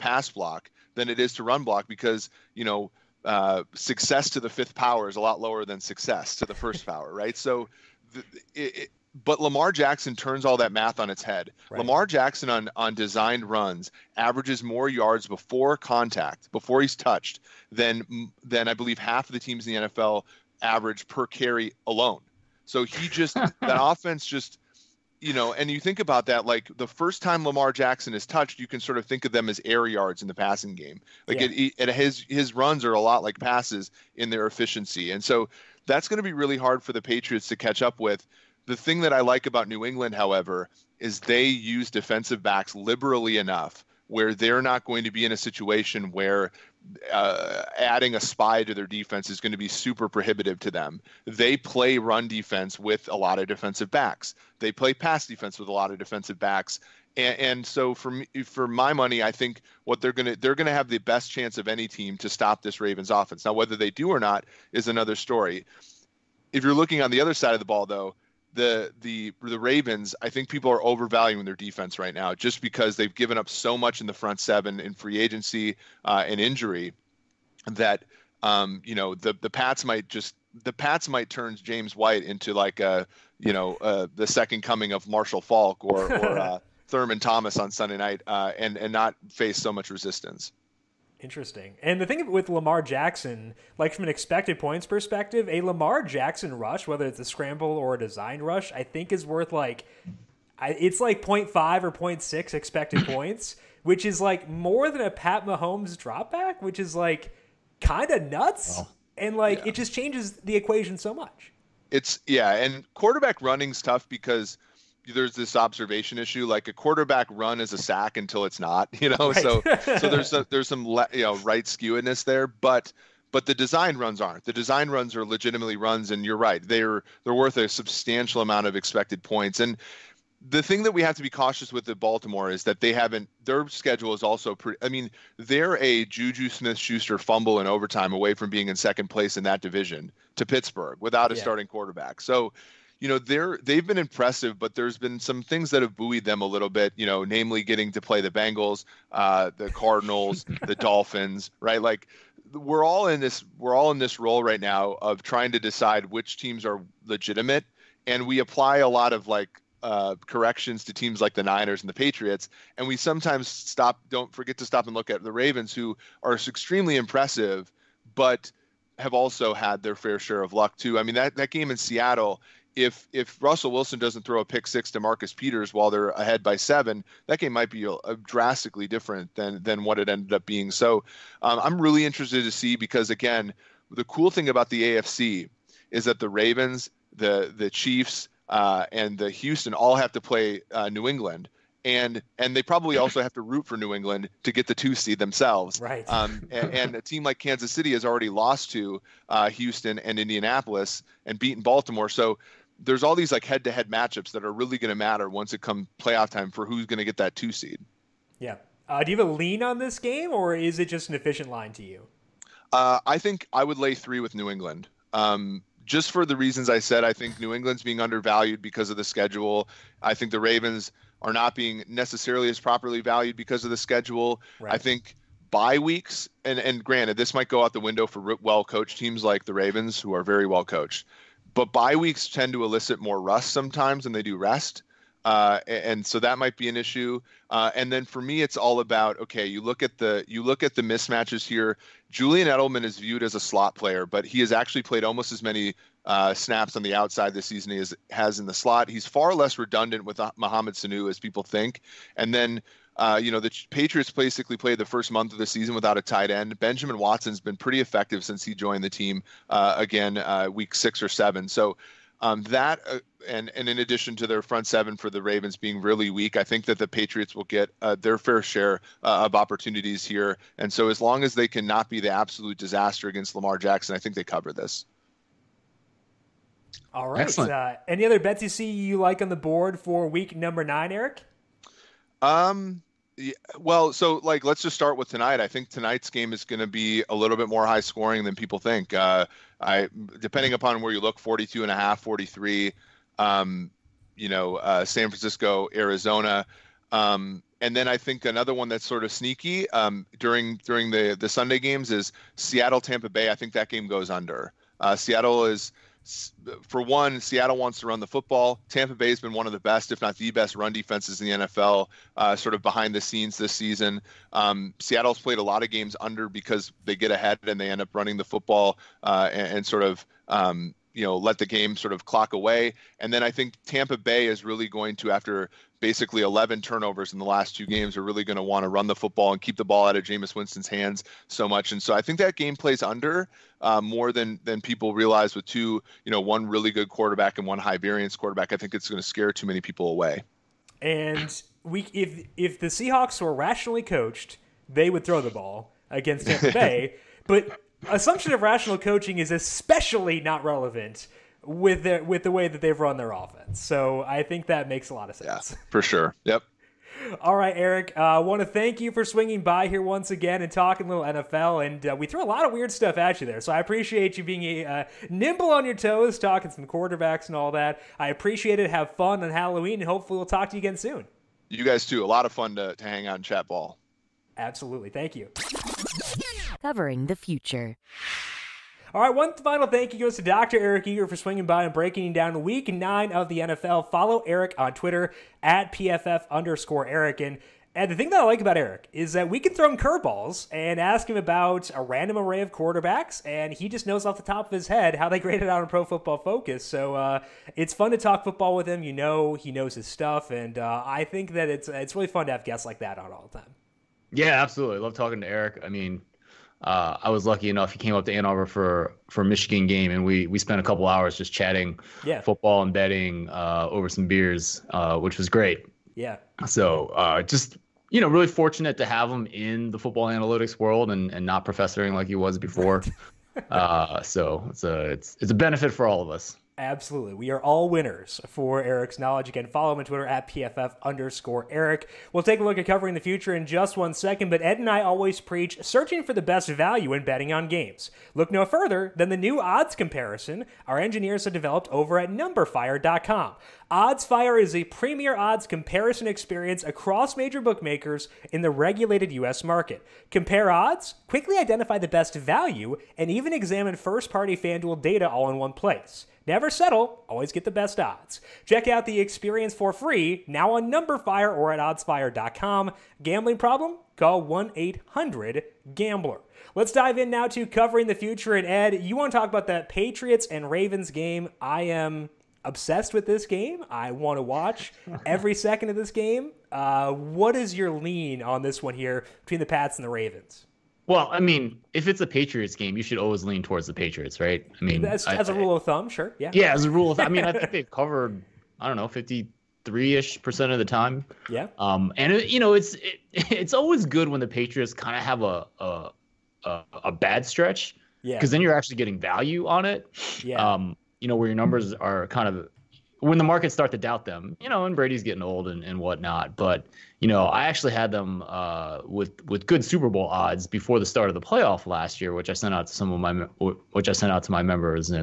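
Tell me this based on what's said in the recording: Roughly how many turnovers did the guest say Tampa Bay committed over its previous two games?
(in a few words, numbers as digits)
11.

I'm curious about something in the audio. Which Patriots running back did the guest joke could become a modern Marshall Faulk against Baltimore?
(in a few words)
James White.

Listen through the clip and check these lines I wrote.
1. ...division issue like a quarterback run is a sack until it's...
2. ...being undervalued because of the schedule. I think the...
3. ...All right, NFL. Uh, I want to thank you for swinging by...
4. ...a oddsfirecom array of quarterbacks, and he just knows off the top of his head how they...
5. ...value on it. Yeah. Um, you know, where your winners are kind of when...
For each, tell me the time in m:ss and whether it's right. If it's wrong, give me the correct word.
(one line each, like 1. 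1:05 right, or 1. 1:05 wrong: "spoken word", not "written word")
1. 1:55 wrong: "observation", not "division"
2. 3:37 right
3. 5:57 wrong: "Eric", not "NFL"
4. 6:31 wrong: "random", not "oddsfirecom"
5. 8:18 wrong: "numbers", not "winners".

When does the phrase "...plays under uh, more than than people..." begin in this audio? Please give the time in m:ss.
5:32.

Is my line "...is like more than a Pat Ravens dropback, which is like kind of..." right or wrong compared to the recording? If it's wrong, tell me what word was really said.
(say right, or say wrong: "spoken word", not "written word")
wrong: "Mahomes", not "Ravens".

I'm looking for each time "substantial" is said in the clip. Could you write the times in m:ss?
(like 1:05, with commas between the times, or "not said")
2:07.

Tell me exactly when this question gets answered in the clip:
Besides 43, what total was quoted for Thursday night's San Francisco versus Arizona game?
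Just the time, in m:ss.
4:51.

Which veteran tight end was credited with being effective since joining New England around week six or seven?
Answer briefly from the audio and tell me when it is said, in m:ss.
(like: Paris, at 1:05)
Benjamin Watson, at 4:16.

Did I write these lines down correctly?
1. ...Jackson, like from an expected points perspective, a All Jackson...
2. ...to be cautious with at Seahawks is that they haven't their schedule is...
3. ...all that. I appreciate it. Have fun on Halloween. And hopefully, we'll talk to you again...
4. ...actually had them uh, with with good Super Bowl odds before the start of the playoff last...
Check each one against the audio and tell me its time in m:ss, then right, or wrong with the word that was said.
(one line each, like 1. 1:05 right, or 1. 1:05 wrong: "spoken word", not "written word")
1. 1:32 wrong: "Lamar", not "All"
2. 2:11 wrong: "Baltimore", not "Seahawks"
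3. 6:07 right
4. 8:27 right.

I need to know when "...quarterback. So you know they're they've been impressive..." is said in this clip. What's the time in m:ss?
2:21.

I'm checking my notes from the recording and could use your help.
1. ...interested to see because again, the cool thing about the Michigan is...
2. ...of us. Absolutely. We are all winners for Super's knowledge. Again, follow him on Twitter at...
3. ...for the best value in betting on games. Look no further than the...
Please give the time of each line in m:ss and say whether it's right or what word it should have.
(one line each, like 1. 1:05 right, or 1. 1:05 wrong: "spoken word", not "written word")
1. 3:02 wrong: "AFC", not "Michigan"
2. 7:06 wrong: "Eric", not "Super"
3. 7:16 right.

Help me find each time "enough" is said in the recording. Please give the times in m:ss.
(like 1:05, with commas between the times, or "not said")
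0:43, 6:47.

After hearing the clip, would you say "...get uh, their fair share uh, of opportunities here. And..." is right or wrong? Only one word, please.
right.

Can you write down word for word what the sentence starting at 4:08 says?
He's far less redundant with Mohamed Sanu as people think.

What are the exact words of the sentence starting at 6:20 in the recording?
Eric Eager for swinging by and breaking down week nine of the NFL.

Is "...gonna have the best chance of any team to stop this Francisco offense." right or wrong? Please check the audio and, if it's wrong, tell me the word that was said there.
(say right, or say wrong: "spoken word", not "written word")
wrong: "Ravens", not "Francisco".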